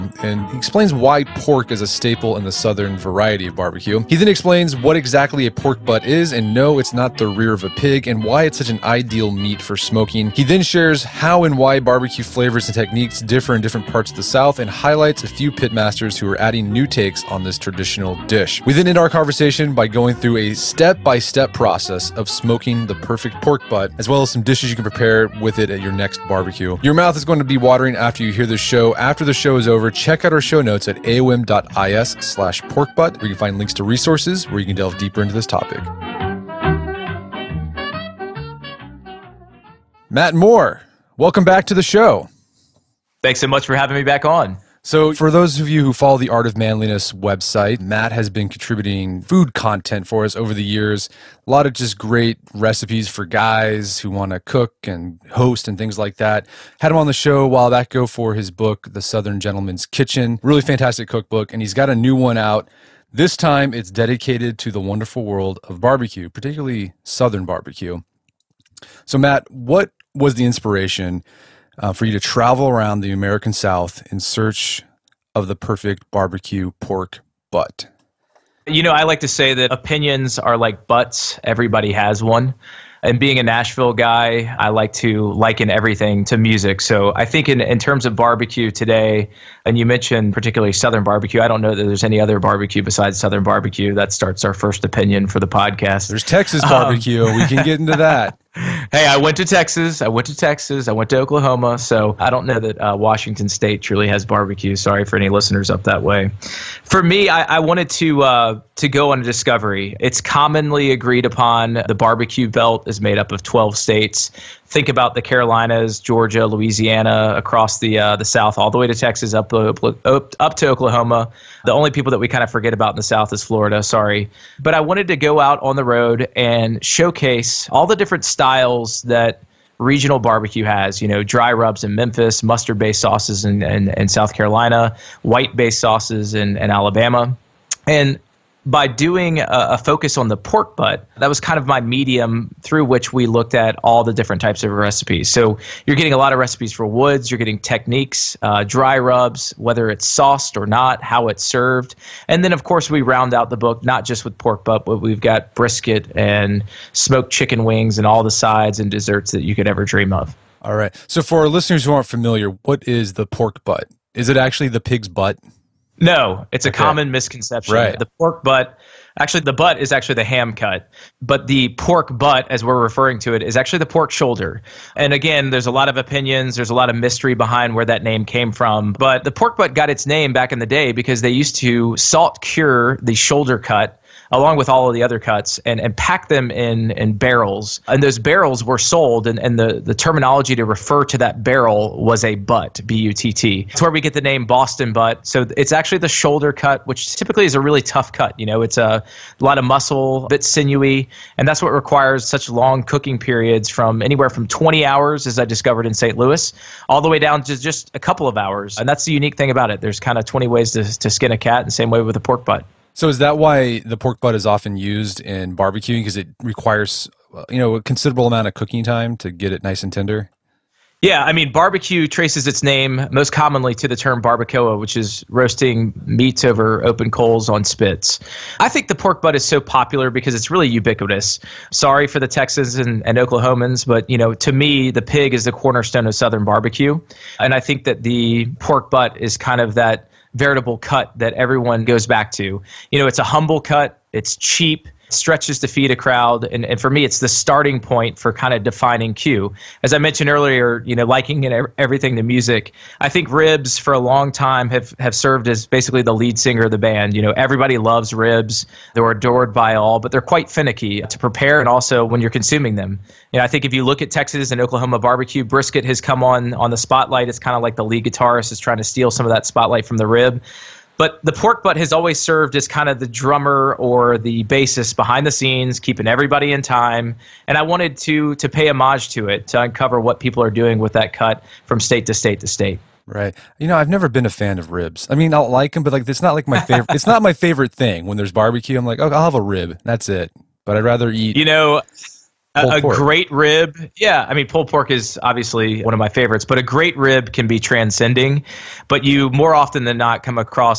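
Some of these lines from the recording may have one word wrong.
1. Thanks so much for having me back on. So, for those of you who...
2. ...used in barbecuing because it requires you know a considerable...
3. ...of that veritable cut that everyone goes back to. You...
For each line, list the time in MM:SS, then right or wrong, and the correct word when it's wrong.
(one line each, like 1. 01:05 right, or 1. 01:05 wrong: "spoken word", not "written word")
1. 00:43 right
2. 03:34 right
3. 03:59 right.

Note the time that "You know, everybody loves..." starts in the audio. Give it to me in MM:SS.
04:17.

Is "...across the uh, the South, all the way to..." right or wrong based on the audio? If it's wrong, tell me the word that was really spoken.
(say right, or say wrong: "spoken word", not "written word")
right.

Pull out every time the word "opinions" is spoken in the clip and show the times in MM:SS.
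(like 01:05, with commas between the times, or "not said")
01:19, 01:34, 02:55.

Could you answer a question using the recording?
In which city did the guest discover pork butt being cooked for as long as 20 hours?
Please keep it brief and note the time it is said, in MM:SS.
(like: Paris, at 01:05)
St. Louis, at 03:25.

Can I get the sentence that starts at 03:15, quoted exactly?
So it's actually the shoulder cut, which typically is a really tough cut.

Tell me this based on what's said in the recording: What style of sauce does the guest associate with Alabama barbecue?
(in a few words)
White based sauces.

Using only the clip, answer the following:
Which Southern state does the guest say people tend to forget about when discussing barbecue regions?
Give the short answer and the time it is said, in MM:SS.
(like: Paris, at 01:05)
Florida, at 02:03.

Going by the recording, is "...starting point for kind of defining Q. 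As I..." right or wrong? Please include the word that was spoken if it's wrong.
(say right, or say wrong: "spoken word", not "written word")
right.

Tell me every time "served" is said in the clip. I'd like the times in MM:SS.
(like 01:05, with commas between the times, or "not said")
02:31, 04:15, 04:32.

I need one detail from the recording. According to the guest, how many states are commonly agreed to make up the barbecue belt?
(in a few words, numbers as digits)
12.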